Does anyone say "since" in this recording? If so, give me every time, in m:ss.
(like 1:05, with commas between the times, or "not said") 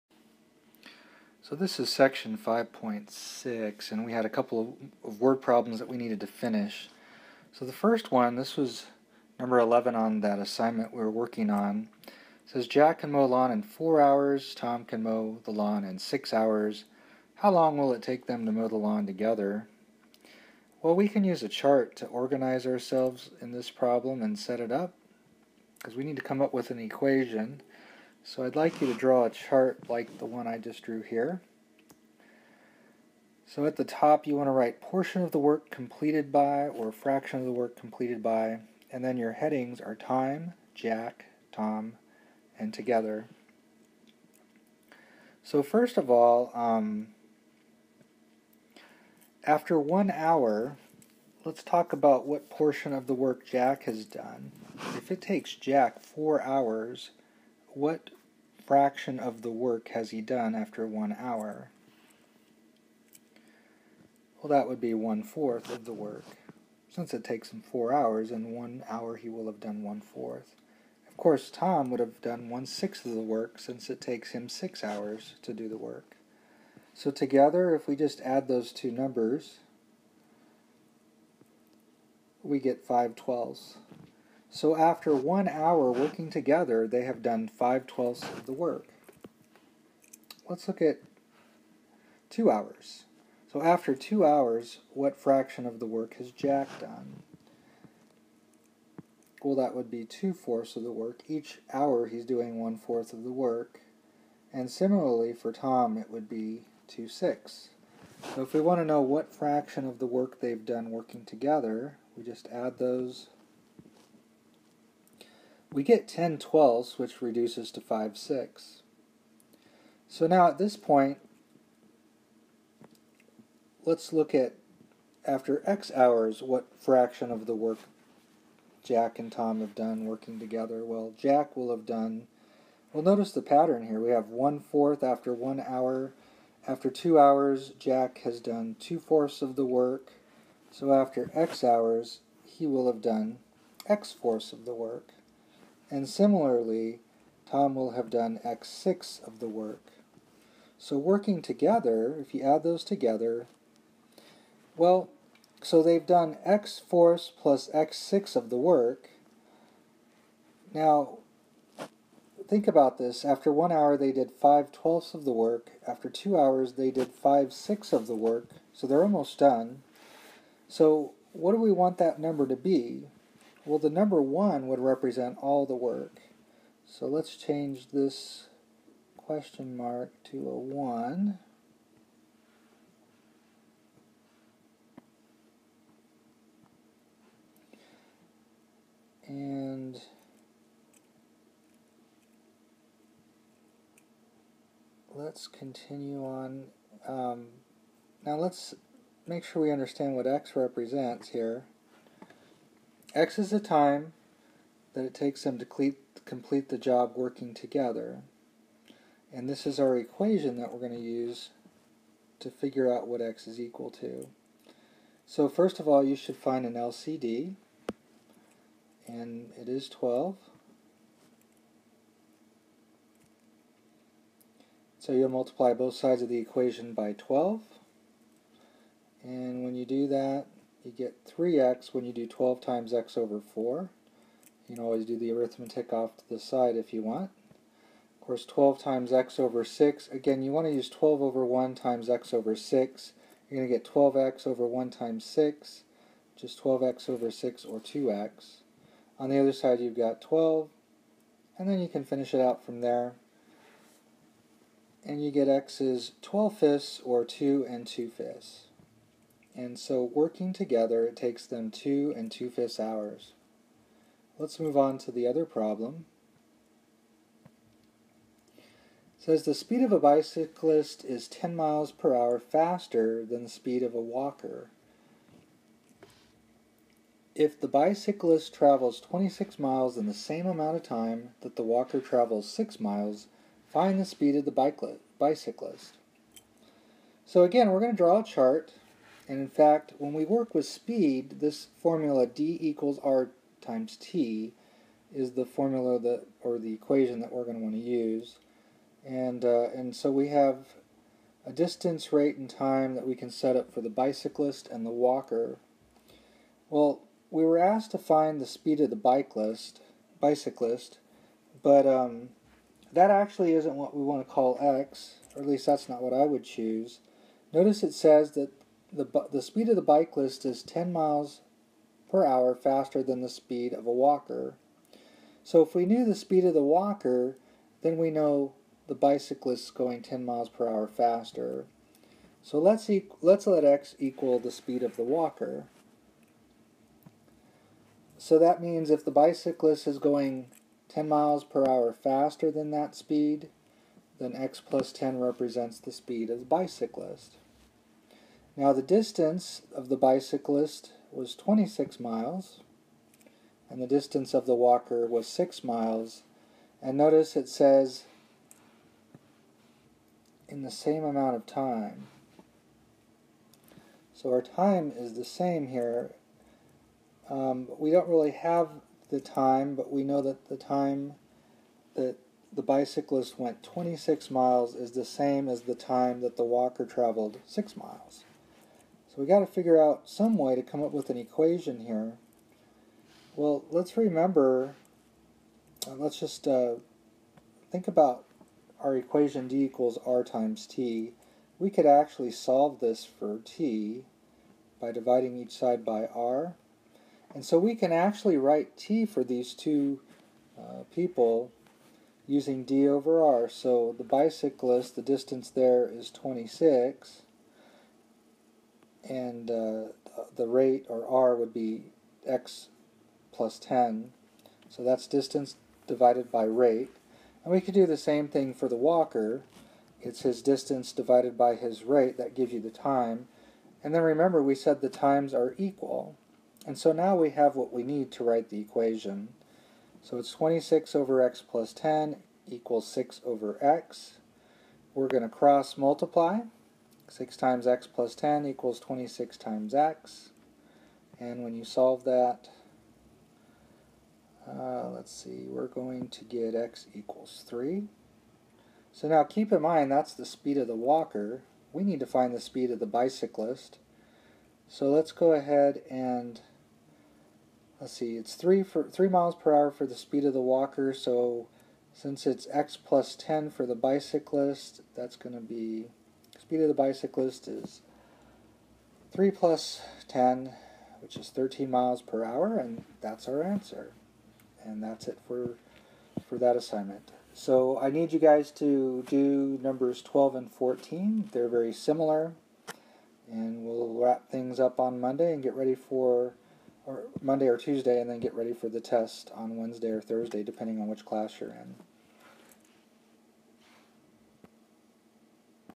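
1:06, 1:13, 7:41.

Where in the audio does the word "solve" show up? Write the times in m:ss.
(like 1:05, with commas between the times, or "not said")
6:32, 7:21.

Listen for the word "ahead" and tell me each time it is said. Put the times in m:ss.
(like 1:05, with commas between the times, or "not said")
7:35.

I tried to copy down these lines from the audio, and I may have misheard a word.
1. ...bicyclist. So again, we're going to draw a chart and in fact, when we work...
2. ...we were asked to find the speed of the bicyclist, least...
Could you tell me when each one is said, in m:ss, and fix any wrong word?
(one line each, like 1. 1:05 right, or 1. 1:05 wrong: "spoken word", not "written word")
1. 4:45 right
2. 5:07 wrong: "bicyclist", not "least".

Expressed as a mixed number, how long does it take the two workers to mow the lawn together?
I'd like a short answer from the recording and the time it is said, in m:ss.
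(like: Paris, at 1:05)
2 and 2/5 hours, at 4:21.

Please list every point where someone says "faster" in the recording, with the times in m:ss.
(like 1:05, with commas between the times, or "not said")
4:32, 5:22, 5:30, 5:41.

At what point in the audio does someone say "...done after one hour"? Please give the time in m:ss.
1:00.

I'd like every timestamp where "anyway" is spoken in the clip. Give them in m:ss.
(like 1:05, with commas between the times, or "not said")
not said.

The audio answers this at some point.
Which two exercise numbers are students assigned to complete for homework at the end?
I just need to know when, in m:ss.
8:00.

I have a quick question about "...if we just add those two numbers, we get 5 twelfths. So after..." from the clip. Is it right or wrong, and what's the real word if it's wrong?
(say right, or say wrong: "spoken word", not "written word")
right.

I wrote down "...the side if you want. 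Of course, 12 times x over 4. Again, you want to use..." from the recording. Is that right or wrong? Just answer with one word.
wrong.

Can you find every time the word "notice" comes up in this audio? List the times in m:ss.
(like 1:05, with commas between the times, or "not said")
2:13, 5:17, 5:56.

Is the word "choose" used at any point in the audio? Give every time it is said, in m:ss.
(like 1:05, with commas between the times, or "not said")
5:16.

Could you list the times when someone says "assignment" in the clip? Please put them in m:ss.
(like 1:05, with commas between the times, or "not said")
0:10, 7:56.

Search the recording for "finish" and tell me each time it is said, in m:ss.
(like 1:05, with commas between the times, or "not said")
0:06, 4:12.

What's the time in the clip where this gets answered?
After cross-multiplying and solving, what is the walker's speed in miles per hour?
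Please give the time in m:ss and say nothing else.
7:38.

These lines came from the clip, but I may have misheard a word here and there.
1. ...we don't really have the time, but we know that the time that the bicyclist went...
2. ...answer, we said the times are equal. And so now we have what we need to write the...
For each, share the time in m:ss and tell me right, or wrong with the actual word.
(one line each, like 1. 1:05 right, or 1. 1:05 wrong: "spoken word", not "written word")
1. 6:07 right
2. 7:04 wrong: "remember", not "answer".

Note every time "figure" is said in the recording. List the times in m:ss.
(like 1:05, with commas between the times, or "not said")
3:32, 6:19.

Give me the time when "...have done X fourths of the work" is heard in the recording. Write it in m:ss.
2:22.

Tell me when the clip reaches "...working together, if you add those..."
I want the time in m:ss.
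2:30.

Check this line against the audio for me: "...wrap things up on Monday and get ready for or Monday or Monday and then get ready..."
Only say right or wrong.
wrong.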